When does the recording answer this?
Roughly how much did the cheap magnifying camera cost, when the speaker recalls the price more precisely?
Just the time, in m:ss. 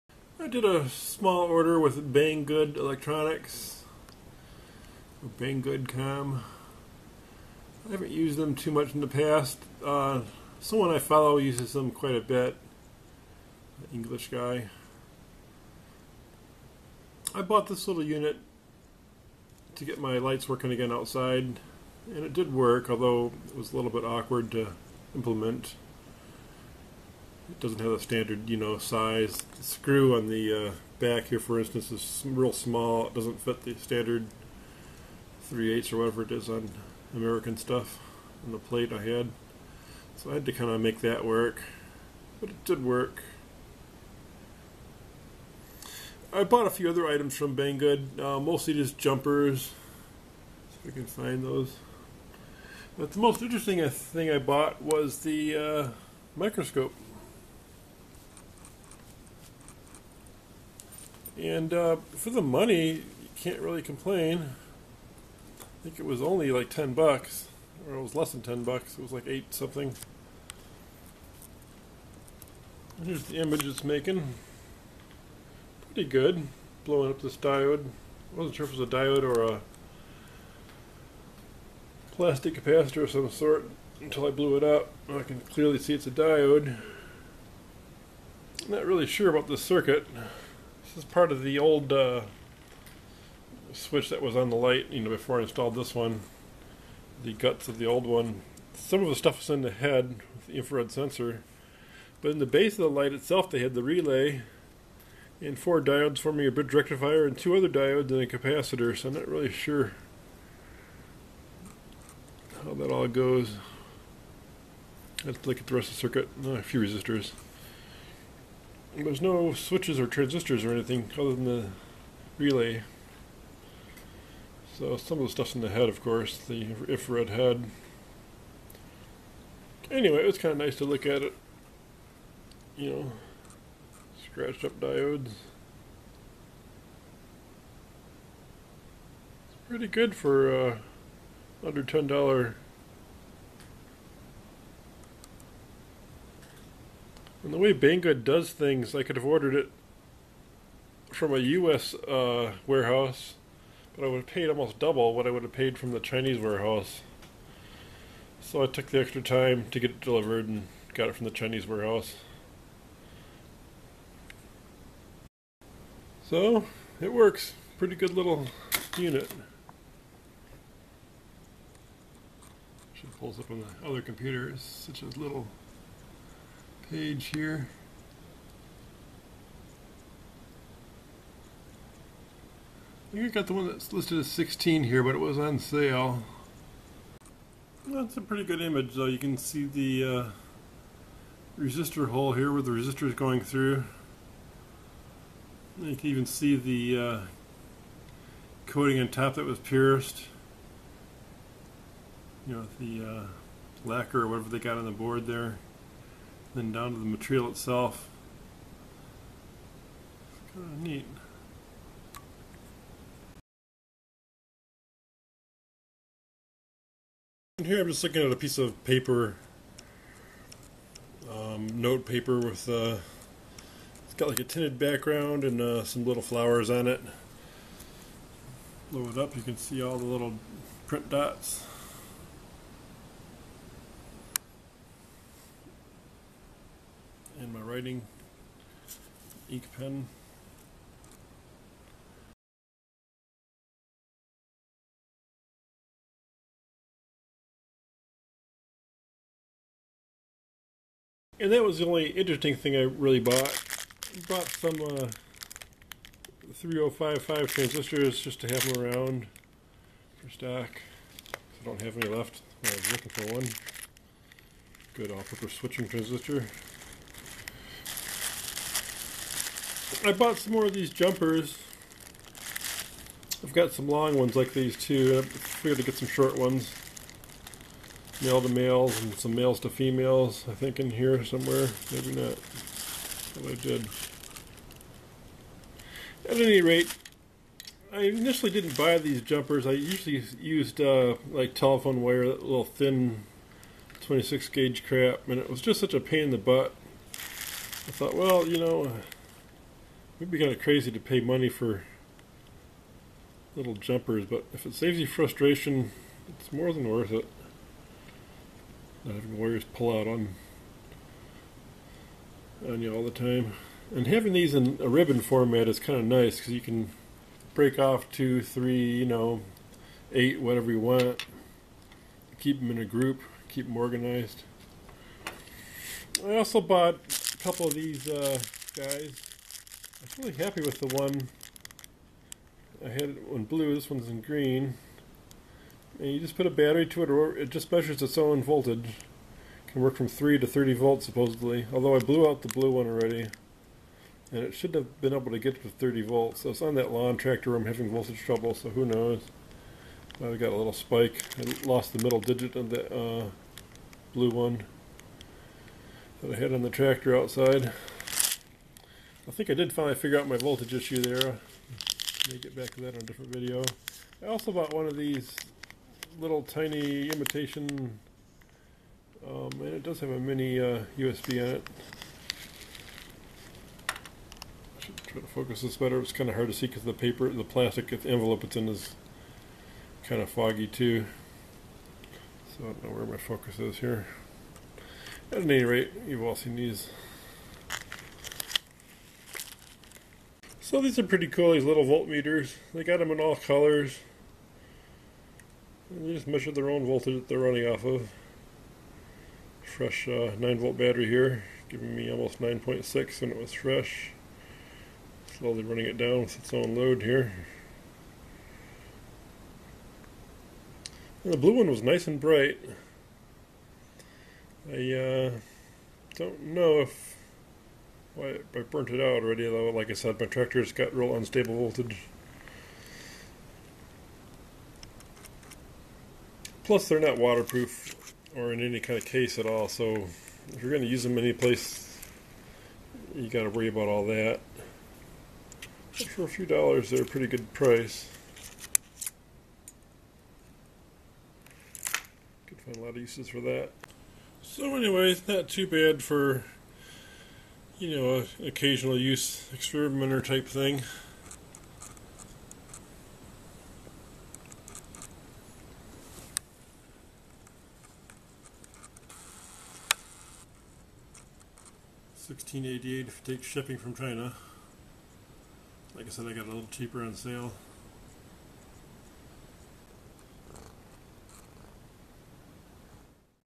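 1:08.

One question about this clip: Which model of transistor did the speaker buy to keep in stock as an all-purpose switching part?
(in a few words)
3055.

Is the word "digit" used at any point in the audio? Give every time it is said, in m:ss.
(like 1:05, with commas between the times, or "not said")
5:52.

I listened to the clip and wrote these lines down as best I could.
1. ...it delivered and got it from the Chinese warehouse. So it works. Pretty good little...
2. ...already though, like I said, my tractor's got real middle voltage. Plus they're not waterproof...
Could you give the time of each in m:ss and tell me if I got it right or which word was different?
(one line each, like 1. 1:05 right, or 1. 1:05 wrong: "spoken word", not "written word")
1. 2:39 right
2. 6:59 wrong: "unstable", not "middle".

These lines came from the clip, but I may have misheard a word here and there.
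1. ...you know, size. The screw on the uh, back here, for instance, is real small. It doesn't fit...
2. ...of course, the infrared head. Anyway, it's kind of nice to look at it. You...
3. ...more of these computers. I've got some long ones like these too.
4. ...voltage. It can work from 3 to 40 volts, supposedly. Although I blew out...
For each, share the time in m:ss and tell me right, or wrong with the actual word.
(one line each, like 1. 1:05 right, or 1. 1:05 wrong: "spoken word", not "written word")
1. 0:28 right
2. 2:05 right
3. 4:30 wrong: "jumpers", not "computers"
4. 5:38 wrong: "30", not "40".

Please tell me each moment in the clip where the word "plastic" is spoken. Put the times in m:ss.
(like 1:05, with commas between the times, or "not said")
1:22, 6:17.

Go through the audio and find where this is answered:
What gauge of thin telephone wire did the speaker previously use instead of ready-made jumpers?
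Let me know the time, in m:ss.
4:54.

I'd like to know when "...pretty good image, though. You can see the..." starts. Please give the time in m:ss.
3:08.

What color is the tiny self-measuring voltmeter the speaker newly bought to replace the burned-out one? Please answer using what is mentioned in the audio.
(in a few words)
Green.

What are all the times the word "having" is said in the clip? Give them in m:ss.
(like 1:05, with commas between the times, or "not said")
5:09, 5:14, 5:47.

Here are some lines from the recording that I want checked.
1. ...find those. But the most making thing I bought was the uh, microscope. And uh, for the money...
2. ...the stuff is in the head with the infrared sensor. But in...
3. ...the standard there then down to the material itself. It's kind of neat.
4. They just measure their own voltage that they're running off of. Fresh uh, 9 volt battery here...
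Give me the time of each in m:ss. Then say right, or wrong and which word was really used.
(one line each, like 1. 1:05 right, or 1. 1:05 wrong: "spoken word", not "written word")
1. 0:51 wrong: "interesting", not "making"
2. 1:39 right
3. 3:24 wrong: "board", not "standard"
4. 6:35 right.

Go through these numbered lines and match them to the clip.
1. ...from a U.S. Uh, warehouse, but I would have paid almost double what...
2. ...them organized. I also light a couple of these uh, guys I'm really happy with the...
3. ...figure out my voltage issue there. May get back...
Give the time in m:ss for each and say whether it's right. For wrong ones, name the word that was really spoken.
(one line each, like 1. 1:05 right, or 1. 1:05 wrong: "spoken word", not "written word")
1. 2:31 right
2. 5:23 wrong: "bought", not "light"
3. 5:59 right.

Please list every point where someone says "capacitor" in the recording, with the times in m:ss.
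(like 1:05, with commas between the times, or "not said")
1:22, 1:48.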